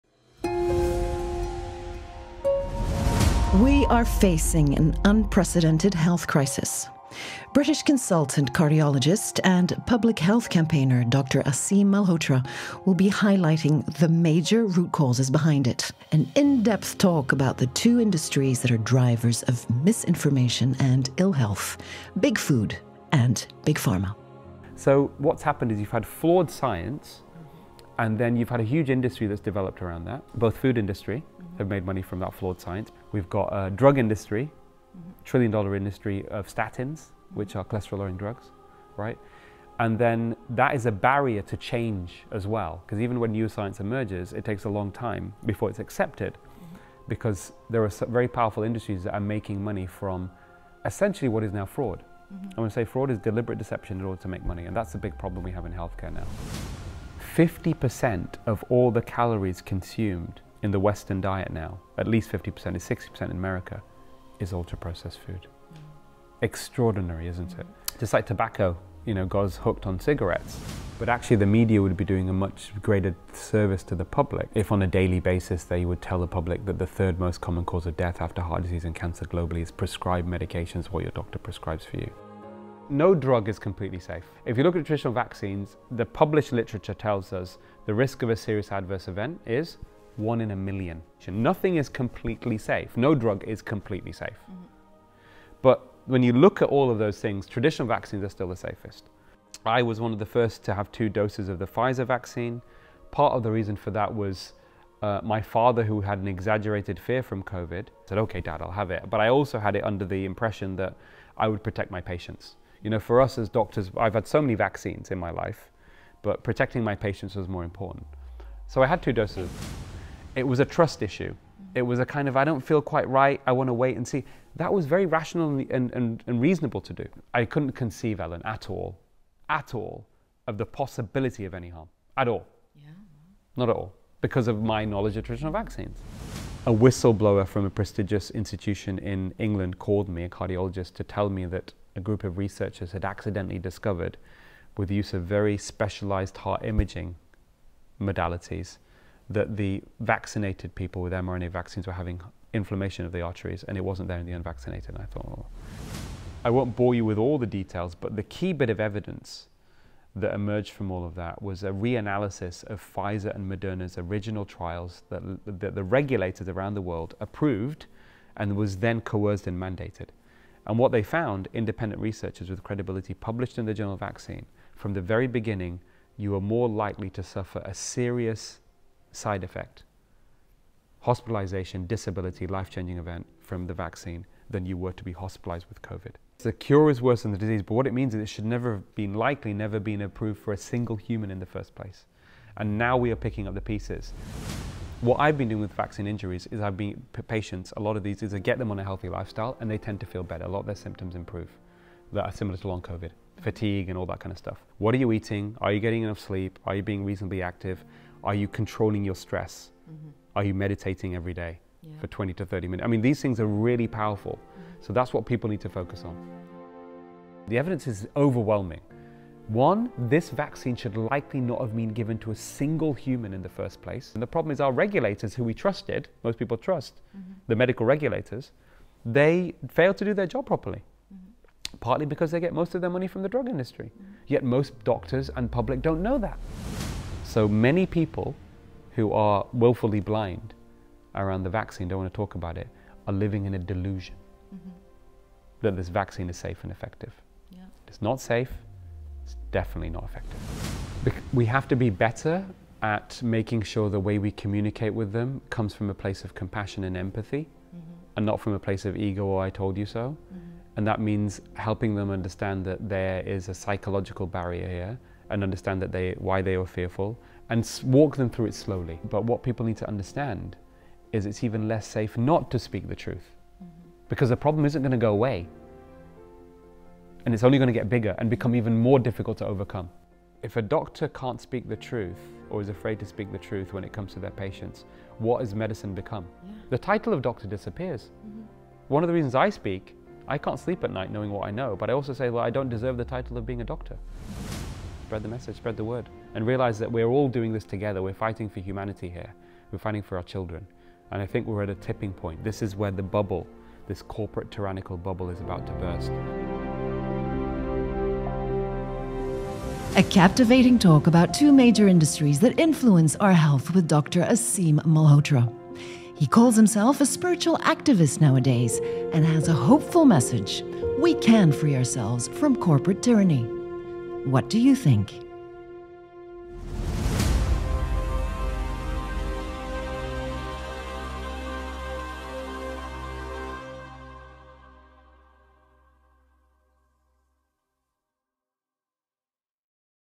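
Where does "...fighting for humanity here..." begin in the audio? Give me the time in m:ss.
4:58.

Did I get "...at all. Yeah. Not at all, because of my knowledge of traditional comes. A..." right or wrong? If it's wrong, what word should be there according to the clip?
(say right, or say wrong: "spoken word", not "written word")
wrong: "vaccines", not "comes".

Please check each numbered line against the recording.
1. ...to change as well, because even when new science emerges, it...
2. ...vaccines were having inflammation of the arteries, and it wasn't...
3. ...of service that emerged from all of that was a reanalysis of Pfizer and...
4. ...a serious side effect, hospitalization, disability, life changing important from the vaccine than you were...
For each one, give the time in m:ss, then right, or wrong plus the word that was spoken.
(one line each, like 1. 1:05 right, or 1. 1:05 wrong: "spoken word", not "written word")
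1. 0:41 right
2. 2:31 right
3. 2:38 wrong: "evidence", not "service"
4. 2:57 wrong: "event", not "important".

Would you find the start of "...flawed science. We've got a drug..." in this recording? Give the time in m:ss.
0:32.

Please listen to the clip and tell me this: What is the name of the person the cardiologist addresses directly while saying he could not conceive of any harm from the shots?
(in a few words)
Ellen.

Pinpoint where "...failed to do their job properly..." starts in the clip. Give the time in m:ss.
3:49.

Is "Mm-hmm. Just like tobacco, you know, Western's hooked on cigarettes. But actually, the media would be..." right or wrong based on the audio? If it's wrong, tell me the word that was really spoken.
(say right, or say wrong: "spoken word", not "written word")
wrong: "God", not "Western".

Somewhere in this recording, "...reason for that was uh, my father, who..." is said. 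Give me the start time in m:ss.
1:43.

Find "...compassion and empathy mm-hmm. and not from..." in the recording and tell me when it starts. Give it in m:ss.
4:16.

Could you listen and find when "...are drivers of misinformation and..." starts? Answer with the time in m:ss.
0:18.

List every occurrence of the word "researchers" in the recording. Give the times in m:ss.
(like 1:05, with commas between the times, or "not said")
2:22, 2:52.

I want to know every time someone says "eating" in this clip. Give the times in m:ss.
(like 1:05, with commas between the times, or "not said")
3:25.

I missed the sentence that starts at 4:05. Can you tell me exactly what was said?
that this vaccine is safe and effective.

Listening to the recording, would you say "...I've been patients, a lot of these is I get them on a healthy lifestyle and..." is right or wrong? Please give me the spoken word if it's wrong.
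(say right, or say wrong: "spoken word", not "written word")
right.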